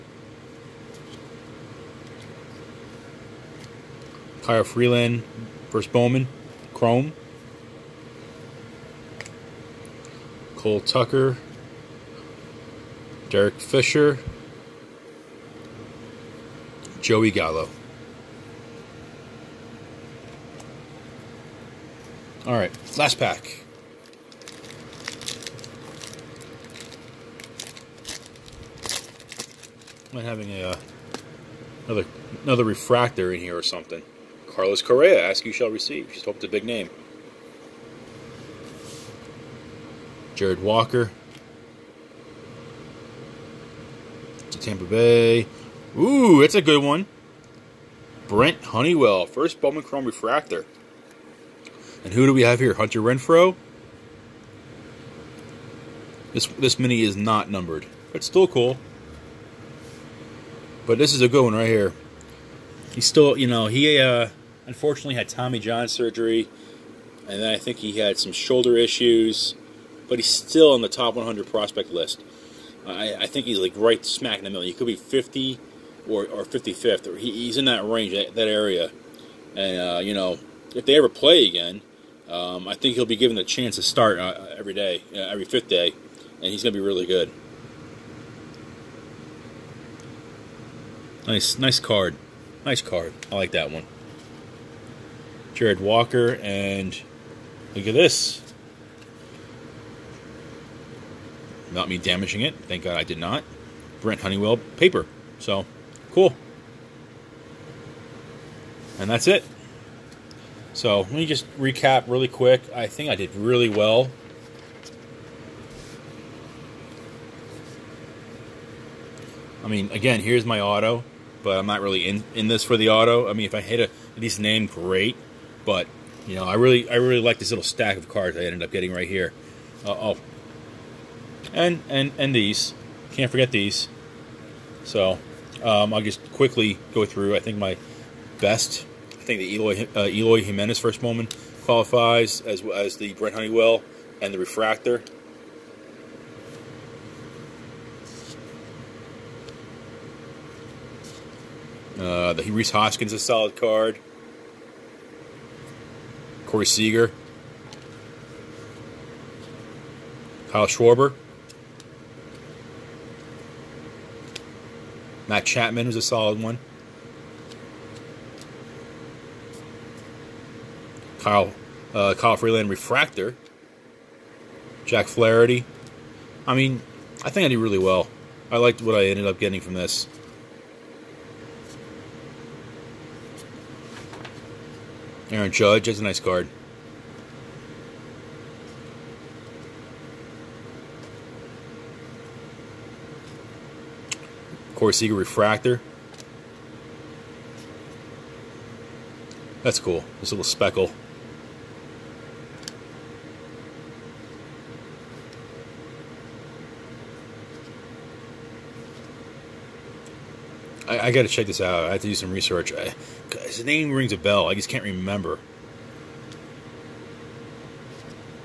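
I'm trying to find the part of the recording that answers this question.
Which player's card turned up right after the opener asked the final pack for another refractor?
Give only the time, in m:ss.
0:34.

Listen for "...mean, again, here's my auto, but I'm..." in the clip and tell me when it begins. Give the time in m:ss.
1:59.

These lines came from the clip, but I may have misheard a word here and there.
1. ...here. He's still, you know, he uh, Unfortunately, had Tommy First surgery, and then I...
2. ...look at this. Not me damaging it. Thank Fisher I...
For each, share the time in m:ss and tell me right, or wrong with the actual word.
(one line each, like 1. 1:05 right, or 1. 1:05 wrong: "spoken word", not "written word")
1. 1:01 wrong: "John", not "First"
2. 1:37 wrong: "God", not "Fisher".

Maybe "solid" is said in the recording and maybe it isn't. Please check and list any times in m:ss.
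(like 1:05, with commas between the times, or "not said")
2:33, 2:46.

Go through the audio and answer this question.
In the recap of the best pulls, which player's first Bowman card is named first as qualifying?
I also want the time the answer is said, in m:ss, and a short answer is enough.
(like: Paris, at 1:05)
Eloy Jimenez, at 2:20.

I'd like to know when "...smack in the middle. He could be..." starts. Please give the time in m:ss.
1:14.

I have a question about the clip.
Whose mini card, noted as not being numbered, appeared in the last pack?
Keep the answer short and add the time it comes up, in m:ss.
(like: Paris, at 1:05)
Hunter Renfroe, at 0:52.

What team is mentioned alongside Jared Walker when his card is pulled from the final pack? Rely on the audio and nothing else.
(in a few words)
Tampa Bay.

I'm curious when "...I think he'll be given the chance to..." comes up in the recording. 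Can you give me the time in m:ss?
1:22.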